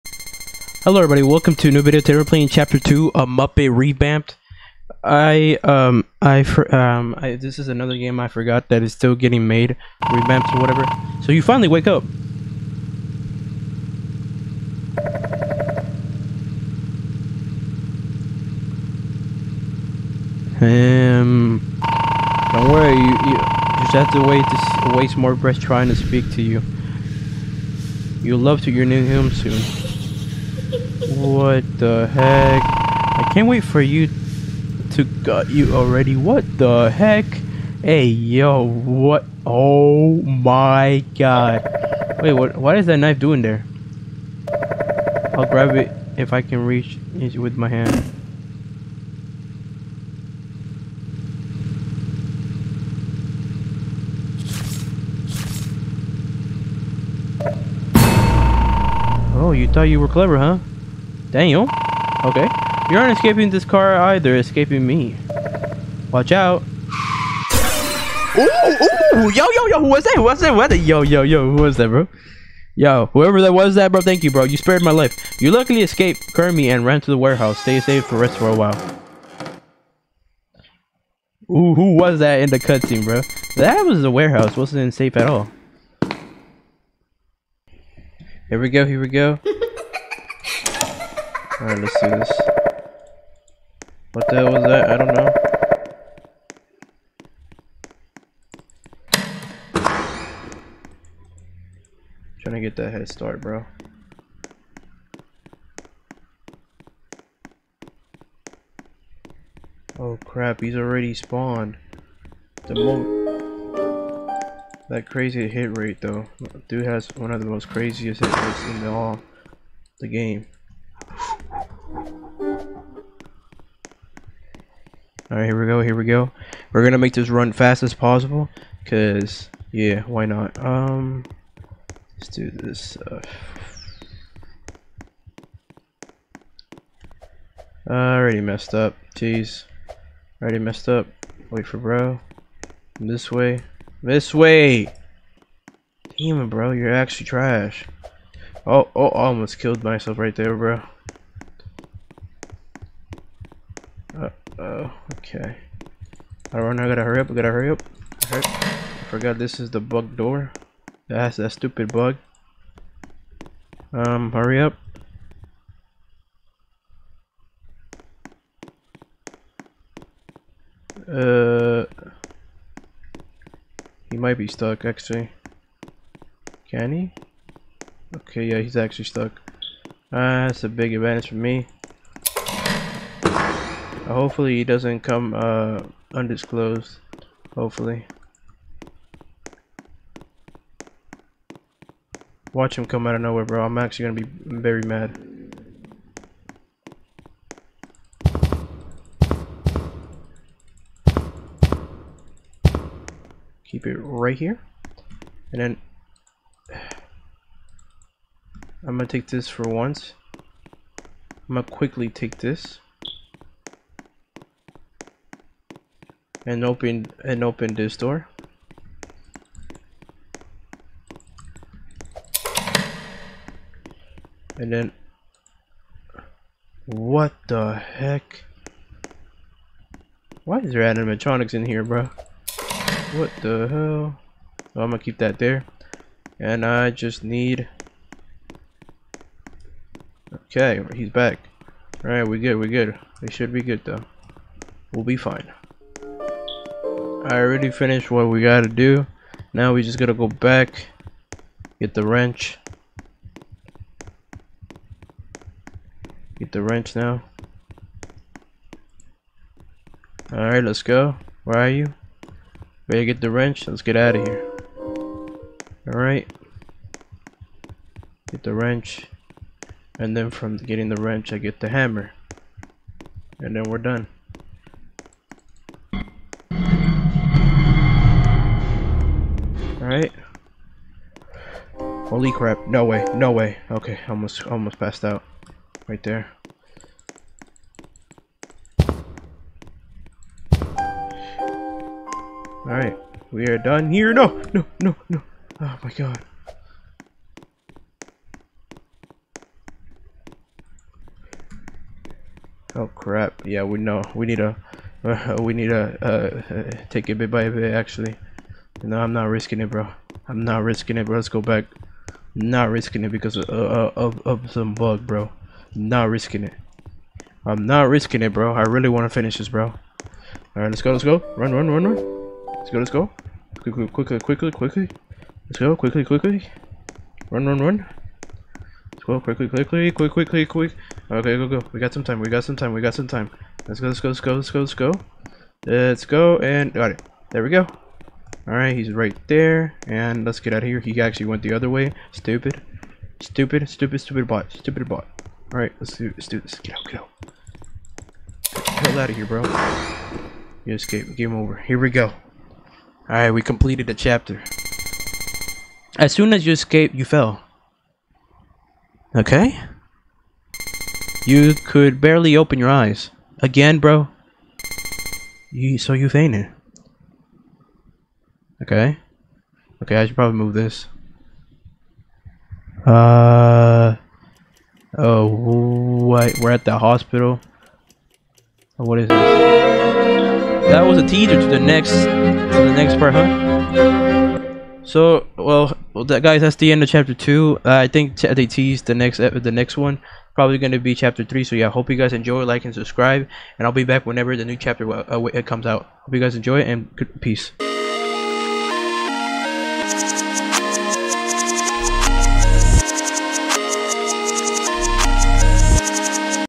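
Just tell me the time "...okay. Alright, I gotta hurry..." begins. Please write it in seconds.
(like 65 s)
155 s.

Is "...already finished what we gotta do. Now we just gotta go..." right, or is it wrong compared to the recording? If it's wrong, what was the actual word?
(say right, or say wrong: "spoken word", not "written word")
right.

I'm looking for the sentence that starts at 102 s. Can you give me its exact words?
trying to get that head start, bro.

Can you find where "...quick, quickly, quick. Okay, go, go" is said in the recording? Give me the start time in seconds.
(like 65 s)
329 s.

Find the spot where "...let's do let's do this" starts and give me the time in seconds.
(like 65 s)
345 s.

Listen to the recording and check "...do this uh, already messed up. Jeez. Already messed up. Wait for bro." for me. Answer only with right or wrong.
right.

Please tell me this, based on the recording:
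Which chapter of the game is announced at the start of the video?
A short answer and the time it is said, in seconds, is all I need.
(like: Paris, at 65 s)
Chapter 2, at 2 s.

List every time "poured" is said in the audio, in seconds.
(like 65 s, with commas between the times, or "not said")
not said.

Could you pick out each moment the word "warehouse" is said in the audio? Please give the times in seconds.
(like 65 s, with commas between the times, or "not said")
77 s, 84 s.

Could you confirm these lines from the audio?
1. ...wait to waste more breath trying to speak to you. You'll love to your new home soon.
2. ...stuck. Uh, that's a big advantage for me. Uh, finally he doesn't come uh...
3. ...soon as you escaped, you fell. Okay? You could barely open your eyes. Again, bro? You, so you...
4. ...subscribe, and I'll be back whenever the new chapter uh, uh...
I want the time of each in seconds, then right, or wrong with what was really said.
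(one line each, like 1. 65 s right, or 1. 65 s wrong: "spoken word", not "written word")
1. 24 s right
2. 179 s wrong: "hopefully", not "finally"
3. 356 s right
4. 392 s right.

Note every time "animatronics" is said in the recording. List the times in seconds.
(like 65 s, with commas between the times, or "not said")
230 s.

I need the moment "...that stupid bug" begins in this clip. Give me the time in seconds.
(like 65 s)
161 s.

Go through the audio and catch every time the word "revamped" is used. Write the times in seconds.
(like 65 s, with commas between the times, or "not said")
3 s, 10 s.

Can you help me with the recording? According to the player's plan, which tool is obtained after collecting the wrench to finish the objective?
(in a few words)
the hammer.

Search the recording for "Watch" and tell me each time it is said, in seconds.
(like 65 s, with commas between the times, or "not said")
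66 s, 192 s.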